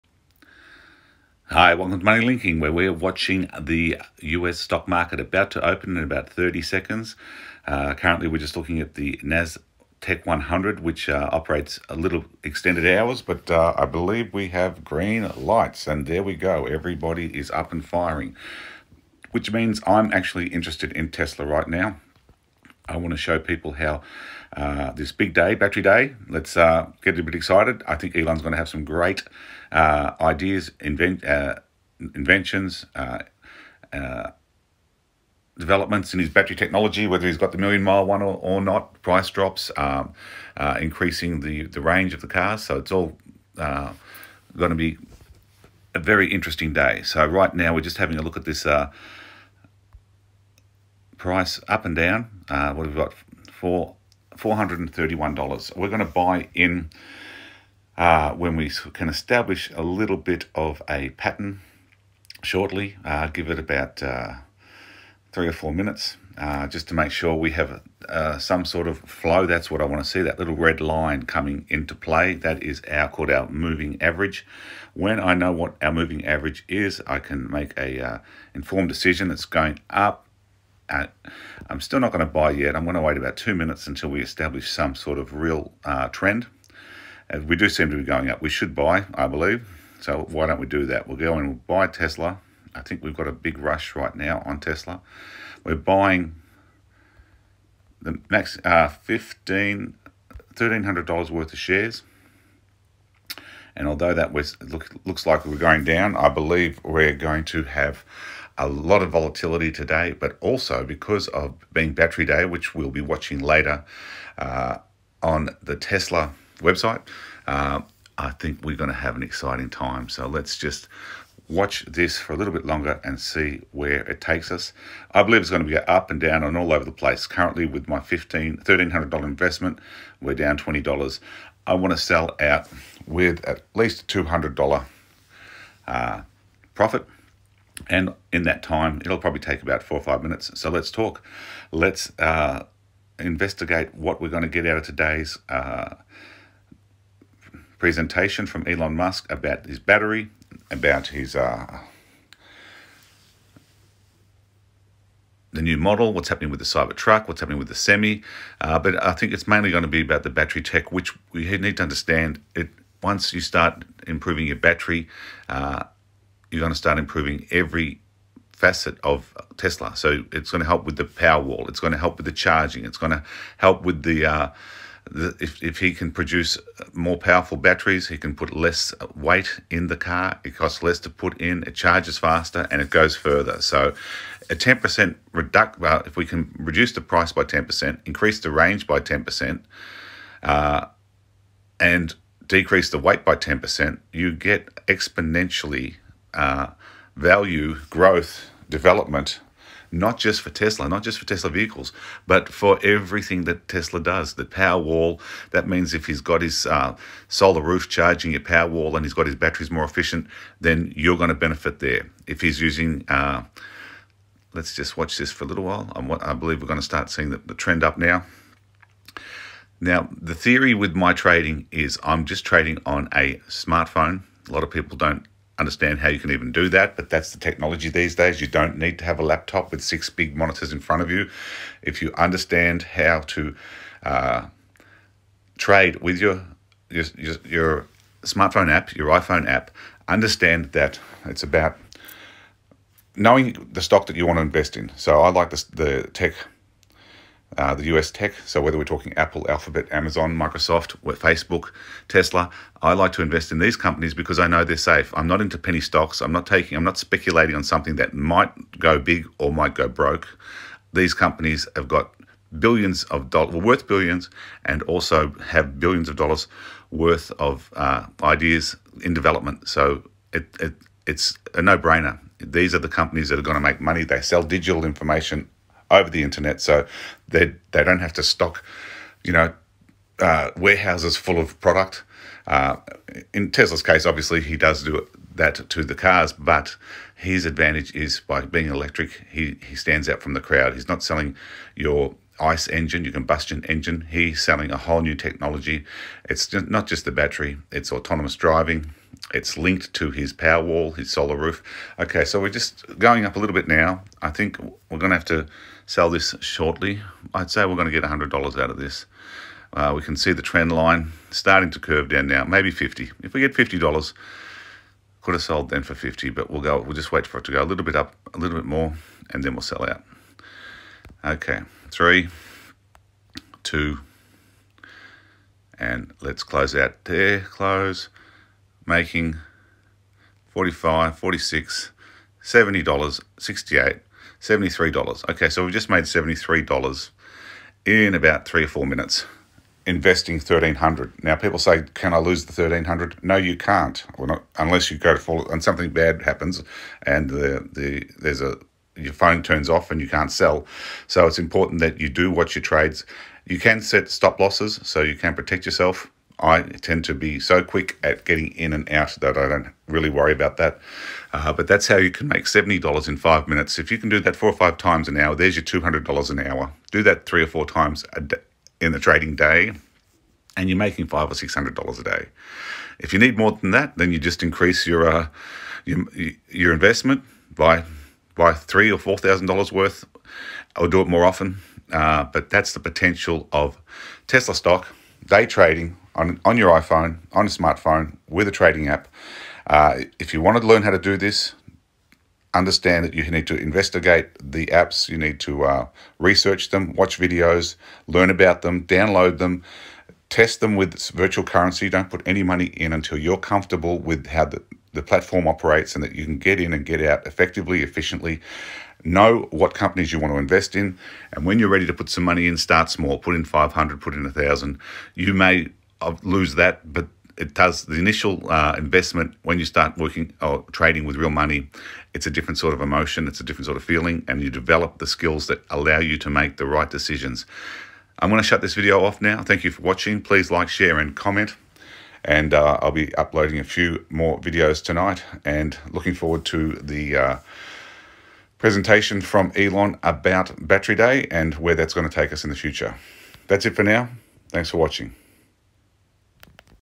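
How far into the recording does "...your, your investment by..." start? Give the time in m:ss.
6:15.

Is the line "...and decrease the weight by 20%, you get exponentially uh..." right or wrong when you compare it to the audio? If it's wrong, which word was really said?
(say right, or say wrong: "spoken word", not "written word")
wrong: "10", not "20".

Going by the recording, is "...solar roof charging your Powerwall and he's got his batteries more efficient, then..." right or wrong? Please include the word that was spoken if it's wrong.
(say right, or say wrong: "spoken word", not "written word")
right.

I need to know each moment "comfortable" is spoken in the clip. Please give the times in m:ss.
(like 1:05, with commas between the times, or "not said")
6:43.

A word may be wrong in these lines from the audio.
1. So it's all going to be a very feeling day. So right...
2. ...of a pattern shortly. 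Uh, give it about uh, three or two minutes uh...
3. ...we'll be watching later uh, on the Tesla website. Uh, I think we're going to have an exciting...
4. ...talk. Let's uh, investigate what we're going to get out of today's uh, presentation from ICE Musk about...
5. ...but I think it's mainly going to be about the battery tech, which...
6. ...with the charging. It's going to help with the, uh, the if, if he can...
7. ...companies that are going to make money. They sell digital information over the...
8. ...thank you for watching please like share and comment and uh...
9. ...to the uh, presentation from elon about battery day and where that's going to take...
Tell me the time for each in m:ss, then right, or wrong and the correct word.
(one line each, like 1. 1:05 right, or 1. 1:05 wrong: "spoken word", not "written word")
1. 0:42 wrong: "interesting", not "feeling"
2. 1:00 wrong: "four", not "two"
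3. 1:52 right
4. 2:20 wrong: "Elon", not "ICE"
5. 2:38 right
6. 2:52 right
7. 4:32 right
8. 7:09 right
9. 7:16 right.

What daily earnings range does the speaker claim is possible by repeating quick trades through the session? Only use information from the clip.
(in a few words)
$500 to $600.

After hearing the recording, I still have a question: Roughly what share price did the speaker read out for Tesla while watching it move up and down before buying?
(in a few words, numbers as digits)
$431.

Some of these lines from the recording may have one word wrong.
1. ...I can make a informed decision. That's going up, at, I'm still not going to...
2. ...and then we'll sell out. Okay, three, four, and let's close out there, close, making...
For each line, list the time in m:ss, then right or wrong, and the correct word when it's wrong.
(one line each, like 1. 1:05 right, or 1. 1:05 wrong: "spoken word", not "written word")
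1. 1:17 right
2. 5:19 wrong: "two", not "four".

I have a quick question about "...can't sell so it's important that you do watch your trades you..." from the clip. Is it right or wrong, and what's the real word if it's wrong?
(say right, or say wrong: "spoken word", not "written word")
right.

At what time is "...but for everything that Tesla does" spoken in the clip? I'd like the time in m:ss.
3:22.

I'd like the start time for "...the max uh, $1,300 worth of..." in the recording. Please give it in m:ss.
1:38.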